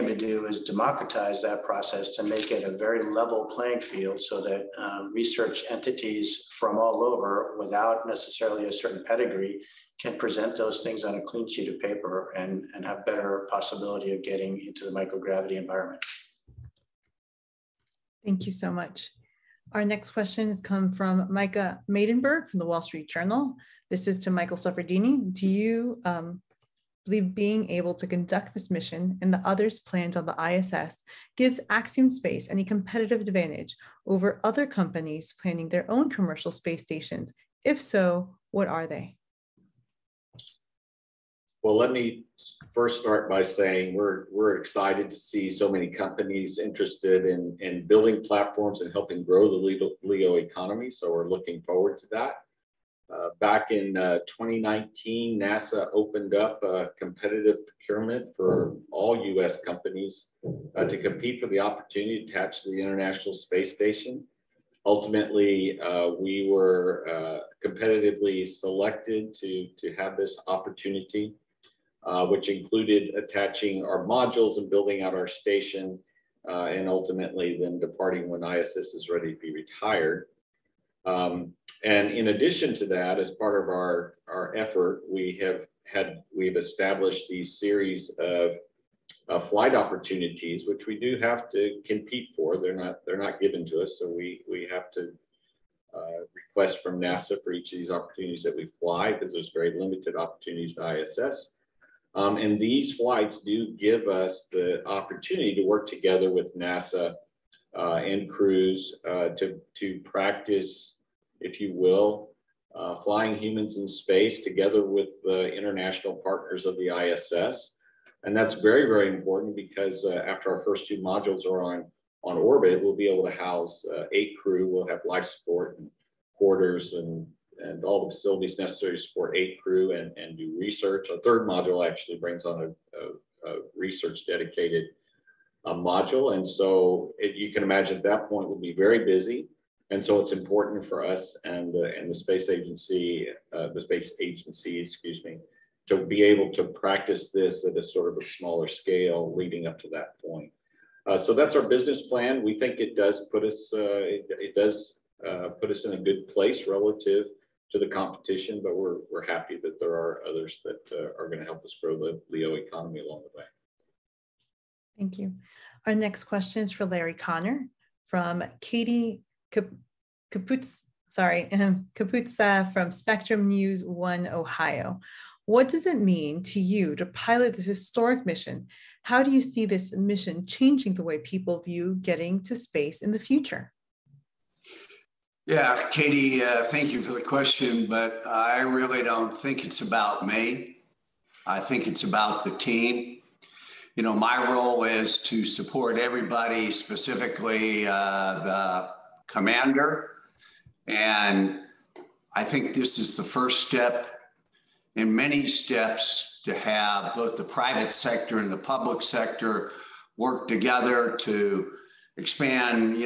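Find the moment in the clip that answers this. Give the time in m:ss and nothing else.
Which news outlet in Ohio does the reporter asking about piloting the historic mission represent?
2:52.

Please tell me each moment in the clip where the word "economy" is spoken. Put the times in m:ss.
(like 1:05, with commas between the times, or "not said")
0:50, 2:42.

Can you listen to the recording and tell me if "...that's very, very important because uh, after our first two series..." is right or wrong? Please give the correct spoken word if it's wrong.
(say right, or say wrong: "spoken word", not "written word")
wrong: "modules", not "series".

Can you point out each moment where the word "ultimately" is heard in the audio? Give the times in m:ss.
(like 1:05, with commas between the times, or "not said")
1:04, 1:16.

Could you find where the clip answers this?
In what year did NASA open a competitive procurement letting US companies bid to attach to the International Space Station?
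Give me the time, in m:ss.
0:54.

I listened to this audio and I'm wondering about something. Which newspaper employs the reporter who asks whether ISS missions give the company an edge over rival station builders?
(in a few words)
Wall Street Journal.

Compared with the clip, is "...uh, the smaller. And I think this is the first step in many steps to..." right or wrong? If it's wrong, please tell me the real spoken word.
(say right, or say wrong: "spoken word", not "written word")
wrong: "commander", not "smaller".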